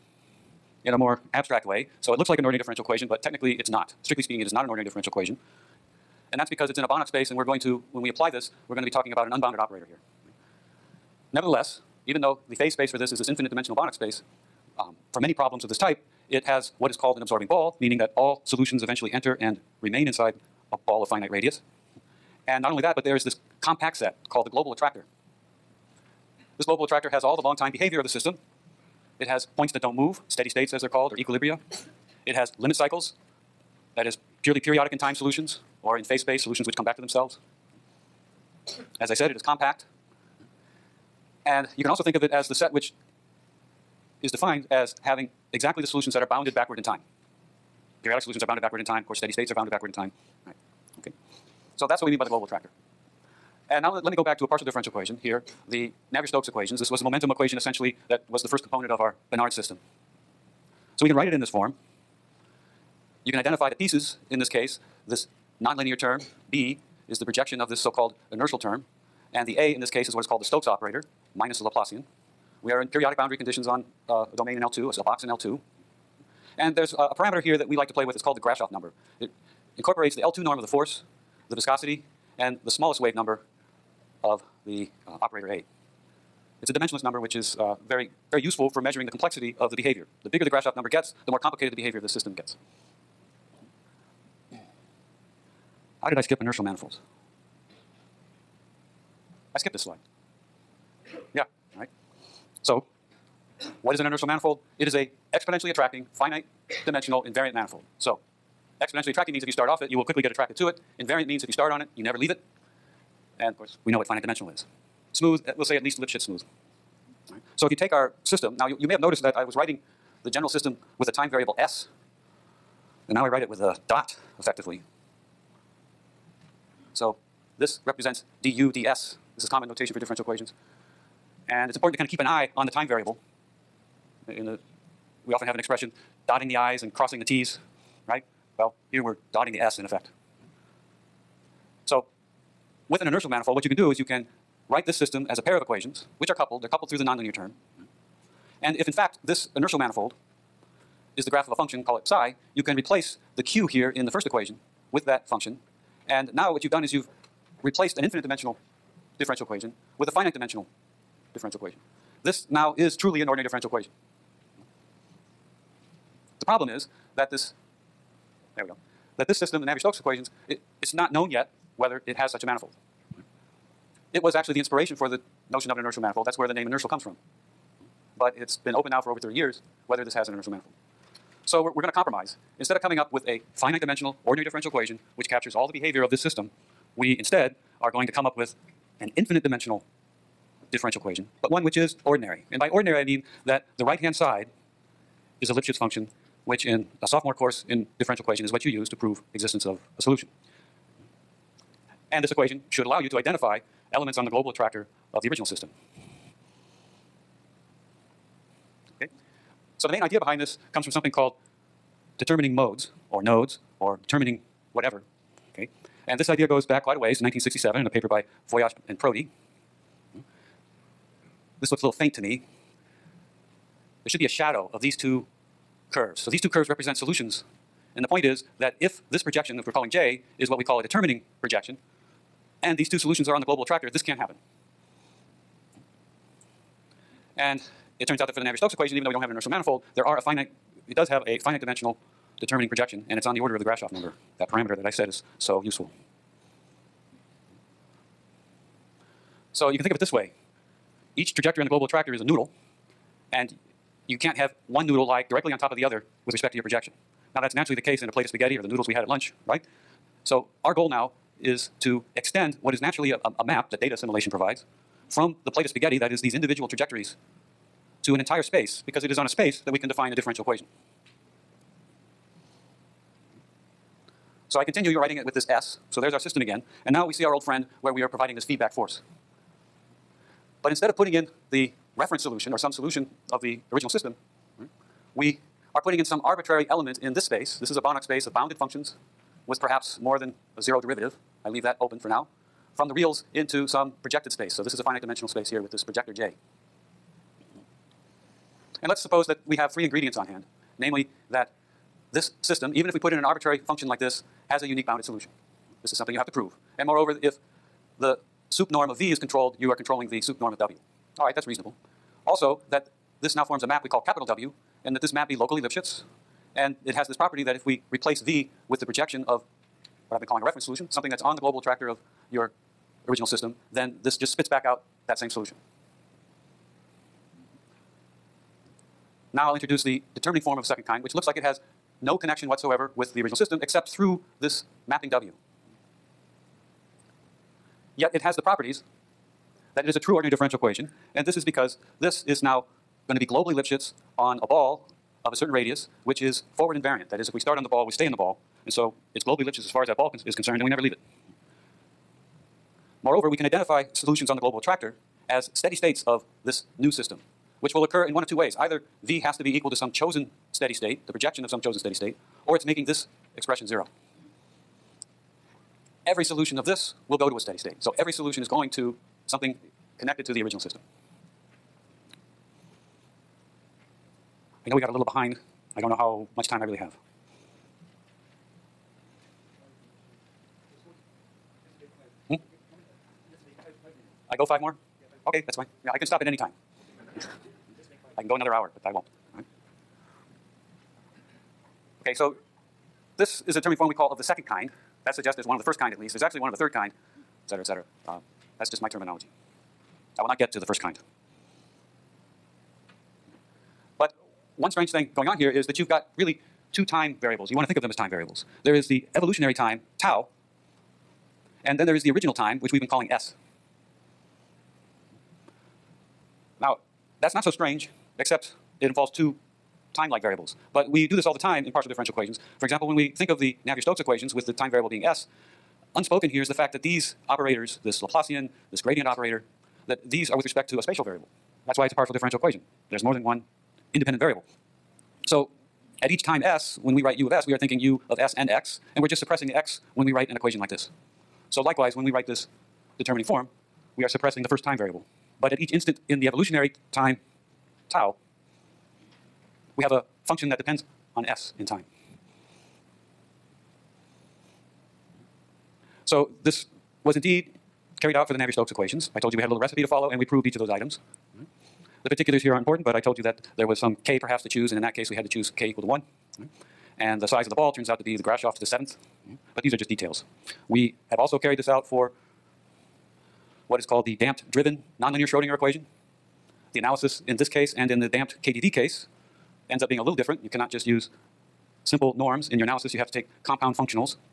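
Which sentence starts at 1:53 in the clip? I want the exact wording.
And of course, we know what finite dimensional is.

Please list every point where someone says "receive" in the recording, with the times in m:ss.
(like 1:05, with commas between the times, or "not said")
not said.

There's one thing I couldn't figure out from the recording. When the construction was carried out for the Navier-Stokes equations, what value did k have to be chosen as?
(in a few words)
1.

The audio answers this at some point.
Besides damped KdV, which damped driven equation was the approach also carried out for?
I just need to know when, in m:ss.
7:54.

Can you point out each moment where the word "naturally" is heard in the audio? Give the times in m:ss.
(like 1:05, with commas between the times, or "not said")
4:17, 4:22.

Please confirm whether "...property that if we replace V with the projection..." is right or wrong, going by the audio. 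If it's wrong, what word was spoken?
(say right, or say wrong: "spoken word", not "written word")
right.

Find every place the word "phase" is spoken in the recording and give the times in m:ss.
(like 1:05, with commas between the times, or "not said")
0:12, 0:36.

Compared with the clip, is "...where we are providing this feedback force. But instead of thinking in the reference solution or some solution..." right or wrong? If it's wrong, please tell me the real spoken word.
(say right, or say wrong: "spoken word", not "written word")
wrong: "putting", not "thinking".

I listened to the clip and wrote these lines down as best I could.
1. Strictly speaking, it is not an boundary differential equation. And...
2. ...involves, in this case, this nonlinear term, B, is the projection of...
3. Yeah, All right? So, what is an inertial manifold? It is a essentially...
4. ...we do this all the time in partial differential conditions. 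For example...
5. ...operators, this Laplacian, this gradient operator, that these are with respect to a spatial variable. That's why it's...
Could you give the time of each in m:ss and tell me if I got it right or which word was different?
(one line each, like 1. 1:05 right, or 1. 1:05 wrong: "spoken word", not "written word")
1. 0:04 wrong: "ordinary", not "boundary"
2. 1:03 wrong: "pieces", not "involves"
3. 1:41 wrong: "exponentially", not "essentially"
4. 7:00 wrong: "equations", not "conditions"
5. 7:07 right.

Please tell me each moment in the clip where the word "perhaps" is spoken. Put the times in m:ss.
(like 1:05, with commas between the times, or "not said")
4:49, 7:44.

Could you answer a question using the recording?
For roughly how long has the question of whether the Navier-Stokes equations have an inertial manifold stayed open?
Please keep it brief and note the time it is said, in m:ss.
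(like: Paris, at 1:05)
Over 30 years, at 2:59.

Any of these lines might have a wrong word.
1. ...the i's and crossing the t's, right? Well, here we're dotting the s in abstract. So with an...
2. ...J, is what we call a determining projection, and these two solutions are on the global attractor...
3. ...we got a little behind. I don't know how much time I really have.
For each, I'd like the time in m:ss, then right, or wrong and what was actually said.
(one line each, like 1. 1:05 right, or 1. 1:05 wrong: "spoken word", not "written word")
1. 2:16 wrong: "effect", not "abstract"
2. 3:49 right
3. 6:14 right.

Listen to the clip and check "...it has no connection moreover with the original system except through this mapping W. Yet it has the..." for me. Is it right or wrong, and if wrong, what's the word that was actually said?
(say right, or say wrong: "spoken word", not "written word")
wrong: "whatsoever", not "moreover".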